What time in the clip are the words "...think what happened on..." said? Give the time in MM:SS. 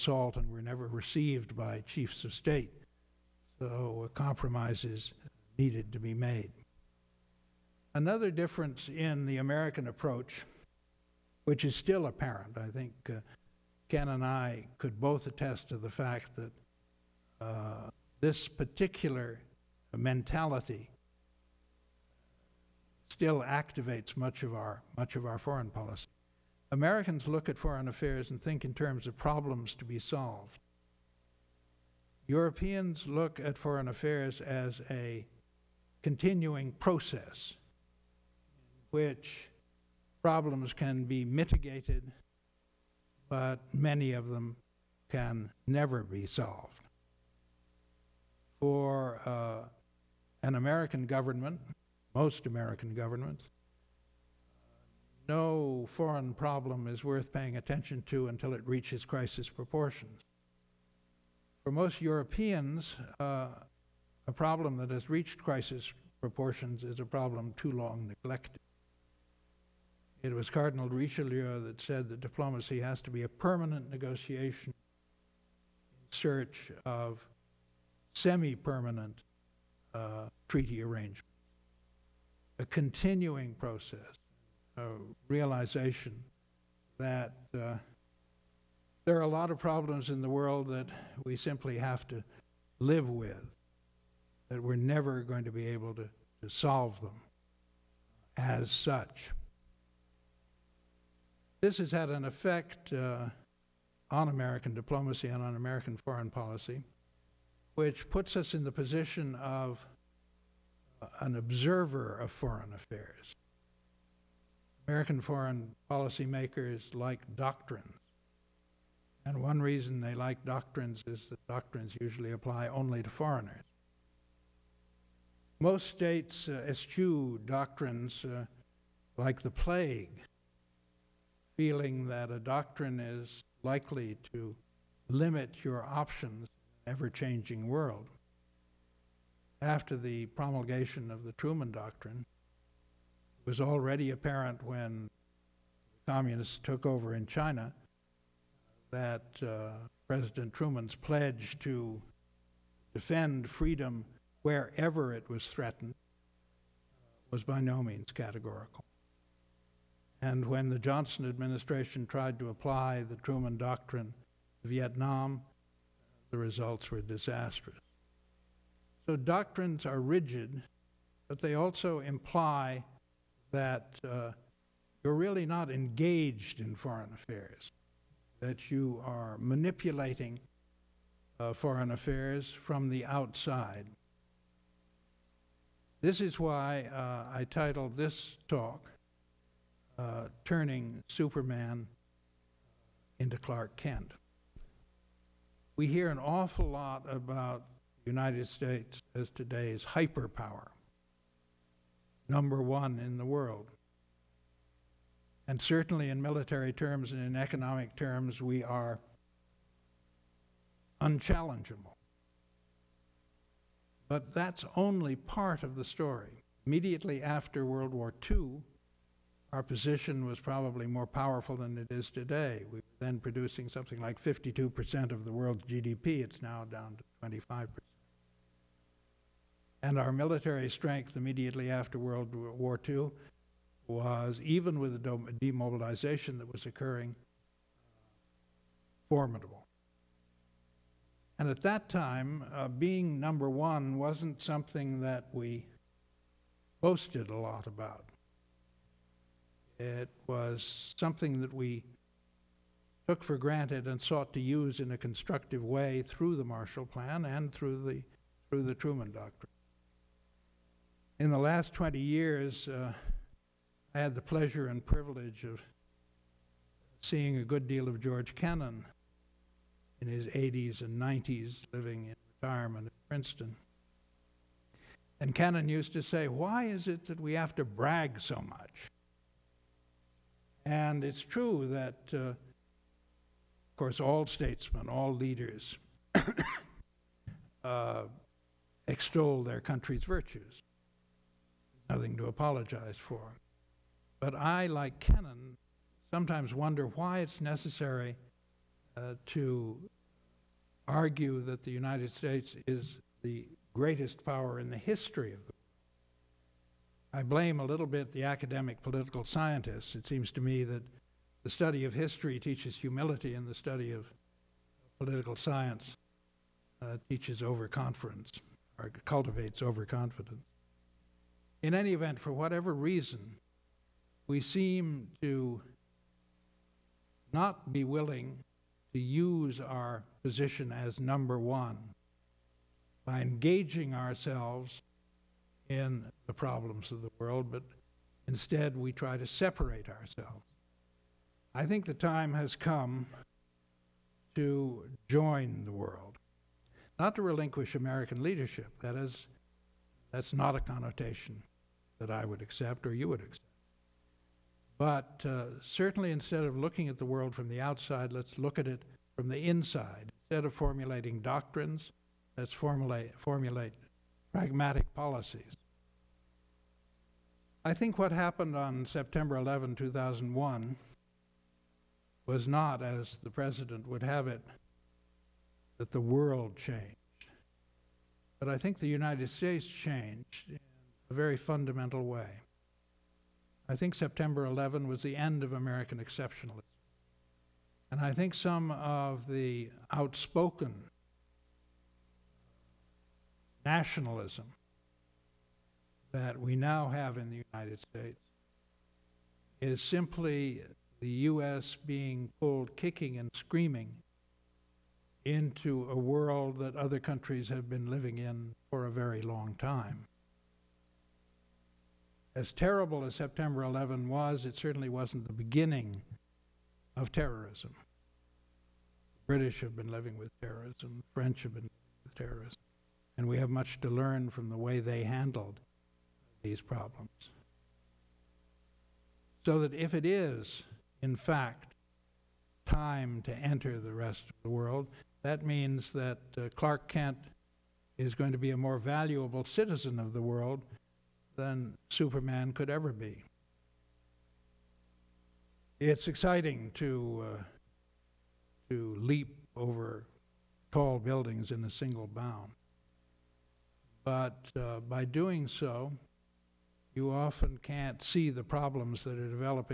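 06:07.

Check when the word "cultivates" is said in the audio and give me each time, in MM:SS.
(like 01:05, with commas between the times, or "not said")
05:19.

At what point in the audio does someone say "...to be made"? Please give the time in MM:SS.
00:05.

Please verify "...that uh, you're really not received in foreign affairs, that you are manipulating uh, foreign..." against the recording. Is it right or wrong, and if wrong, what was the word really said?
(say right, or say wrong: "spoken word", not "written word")
wrong: "engaged", not "received".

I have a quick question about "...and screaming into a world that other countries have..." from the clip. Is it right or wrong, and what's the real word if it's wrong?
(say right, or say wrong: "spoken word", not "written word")
right.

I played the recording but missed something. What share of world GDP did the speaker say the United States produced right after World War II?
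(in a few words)
52%.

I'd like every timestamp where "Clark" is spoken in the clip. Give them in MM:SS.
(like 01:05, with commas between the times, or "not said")
03:13, 07:16.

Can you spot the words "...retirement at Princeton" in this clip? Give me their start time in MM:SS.
04:32.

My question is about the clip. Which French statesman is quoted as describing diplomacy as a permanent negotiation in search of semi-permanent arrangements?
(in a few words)
Cardinal Richelieu.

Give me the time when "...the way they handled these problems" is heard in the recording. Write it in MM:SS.
07:04.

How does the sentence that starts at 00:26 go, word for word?
Americans look at foreign affairs and think in terms of problems to be solved.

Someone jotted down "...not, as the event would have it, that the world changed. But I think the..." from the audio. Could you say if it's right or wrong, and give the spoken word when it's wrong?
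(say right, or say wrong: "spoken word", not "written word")
wrong: "president", not "event".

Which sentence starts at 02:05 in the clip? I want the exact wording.
Most states uh, eschew doctrines uh, like the plague, feeling that a doctrine is likely to limit your options ever changing world.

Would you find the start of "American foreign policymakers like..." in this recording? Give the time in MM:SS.
01:54.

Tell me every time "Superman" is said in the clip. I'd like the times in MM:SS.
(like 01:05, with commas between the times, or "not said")
03:11, 07:21.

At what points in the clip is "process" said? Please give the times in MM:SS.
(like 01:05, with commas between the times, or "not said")
00:36, 01:23.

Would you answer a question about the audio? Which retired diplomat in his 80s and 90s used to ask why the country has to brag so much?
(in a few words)
George Kennan.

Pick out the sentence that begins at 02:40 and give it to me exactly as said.
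And when the Johnson administration tried to apply the Truman Doctrine to Vietnam, the results were disastrous.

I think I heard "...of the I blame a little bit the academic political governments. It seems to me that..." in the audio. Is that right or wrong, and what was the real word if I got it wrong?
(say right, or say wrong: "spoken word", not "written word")
wrong: "scientists", not "governments".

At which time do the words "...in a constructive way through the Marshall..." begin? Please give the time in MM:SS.
04:14.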